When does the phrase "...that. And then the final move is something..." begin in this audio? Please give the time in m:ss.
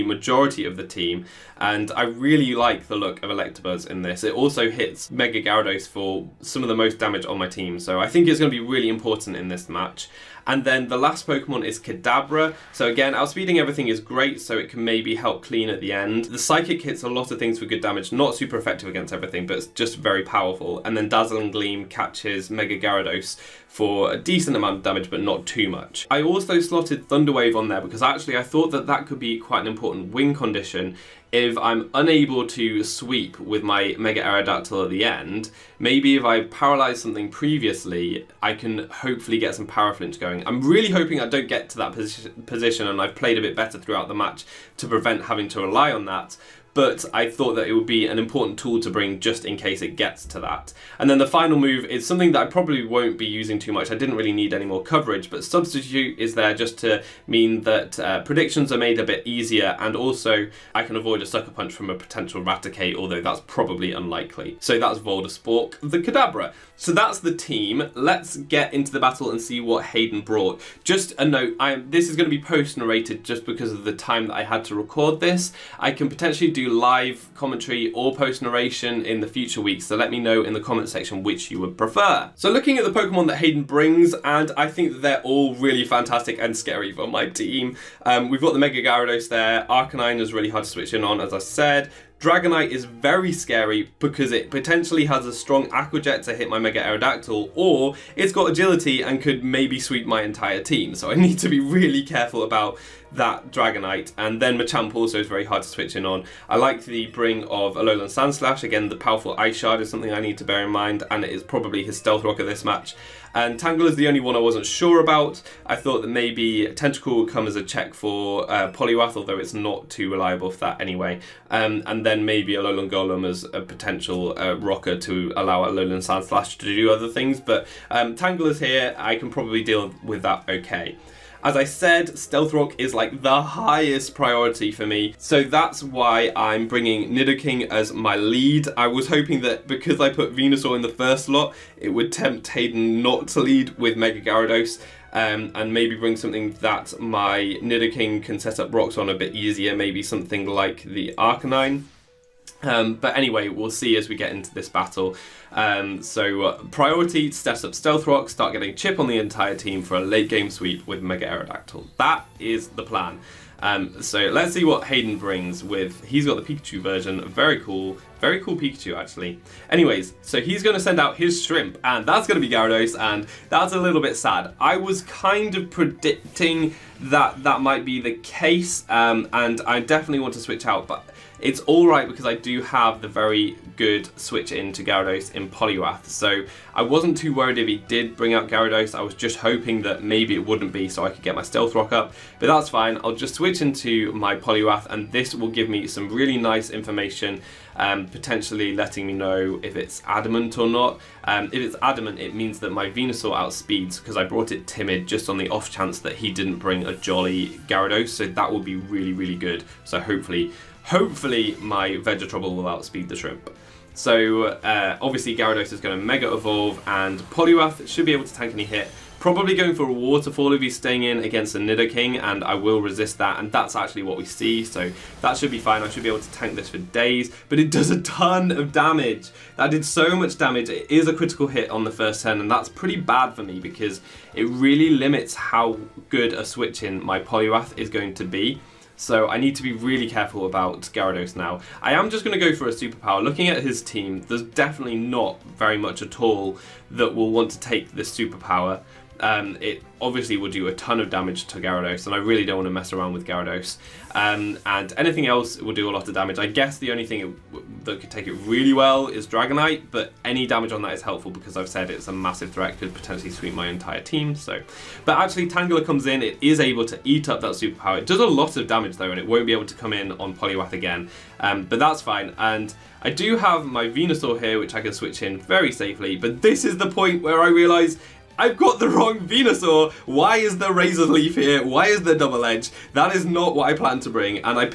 0:50.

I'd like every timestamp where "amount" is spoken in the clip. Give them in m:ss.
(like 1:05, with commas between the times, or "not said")
0:24.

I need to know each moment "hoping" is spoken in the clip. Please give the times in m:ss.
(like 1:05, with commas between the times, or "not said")
0:40, 2:19, 3:09.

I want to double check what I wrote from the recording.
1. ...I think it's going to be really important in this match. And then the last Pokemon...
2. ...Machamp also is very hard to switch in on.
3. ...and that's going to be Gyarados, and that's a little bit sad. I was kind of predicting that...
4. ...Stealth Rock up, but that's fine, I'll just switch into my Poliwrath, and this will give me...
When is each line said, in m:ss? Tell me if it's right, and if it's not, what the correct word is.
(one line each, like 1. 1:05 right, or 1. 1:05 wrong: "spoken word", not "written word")
1. 0:07 right
2. 1:44 right
3. 2:51 right
4. 3:11 right.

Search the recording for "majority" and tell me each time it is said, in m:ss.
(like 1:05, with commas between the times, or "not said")
0:00.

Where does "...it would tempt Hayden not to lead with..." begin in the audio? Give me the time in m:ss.
2:21.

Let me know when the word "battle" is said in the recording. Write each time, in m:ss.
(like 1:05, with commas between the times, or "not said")
1:08, 2:34.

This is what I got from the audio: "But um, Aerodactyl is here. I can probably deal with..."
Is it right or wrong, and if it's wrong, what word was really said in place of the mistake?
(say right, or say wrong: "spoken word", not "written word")
wrong: "Tangela", not "Aerodactyl".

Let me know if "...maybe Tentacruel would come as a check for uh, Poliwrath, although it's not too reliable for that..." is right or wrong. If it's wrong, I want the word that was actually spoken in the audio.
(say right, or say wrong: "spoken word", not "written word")
right.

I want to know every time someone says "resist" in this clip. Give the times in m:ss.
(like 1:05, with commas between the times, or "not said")
3:42.